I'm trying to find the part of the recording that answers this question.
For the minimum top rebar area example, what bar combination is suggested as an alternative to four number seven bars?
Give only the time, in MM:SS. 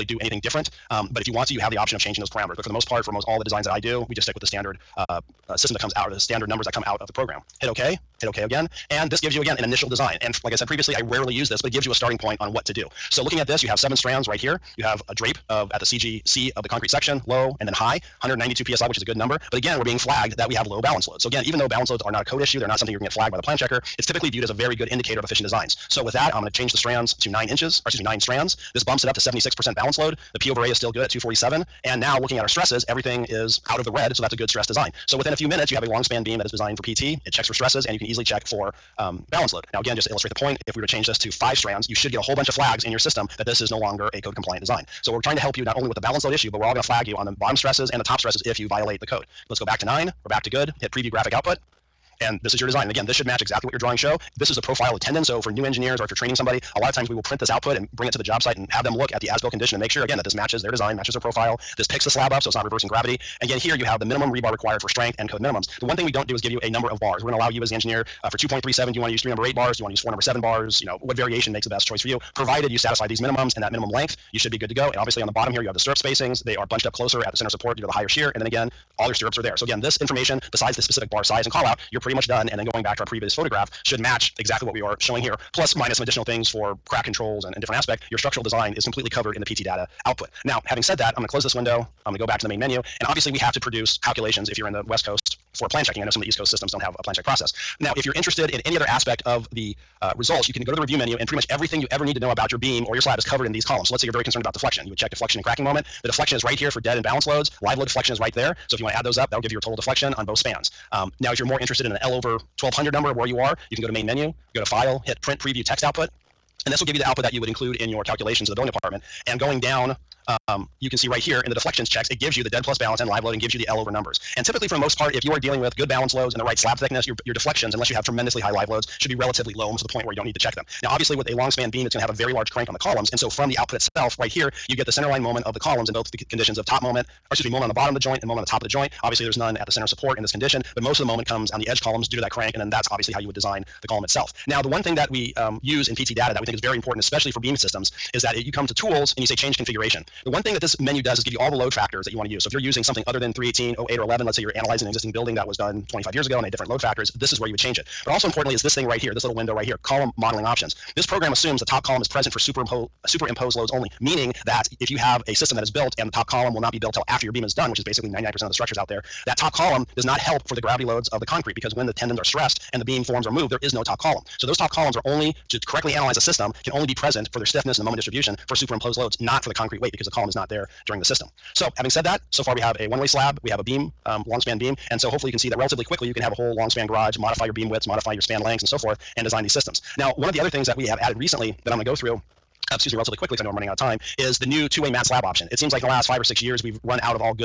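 01:09.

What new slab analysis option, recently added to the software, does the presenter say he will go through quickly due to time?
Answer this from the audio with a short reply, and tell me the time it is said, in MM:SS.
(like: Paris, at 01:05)
two-way mat slab, at 03:14.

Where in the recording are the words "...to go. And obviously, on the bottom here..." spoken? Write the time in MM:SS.
01:14.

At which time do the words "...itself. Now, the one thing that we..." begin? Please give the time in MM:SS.
02:24.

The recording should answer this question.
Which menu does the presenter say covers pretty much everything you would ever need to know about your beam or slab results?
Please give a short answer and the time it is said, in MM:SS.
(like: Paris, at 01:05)
review menu, at 01:40.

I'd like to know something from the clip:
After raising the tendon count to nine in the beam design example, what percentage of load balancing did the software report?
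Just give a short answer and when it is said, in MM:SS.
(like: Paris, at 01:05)
76%, at 00:29.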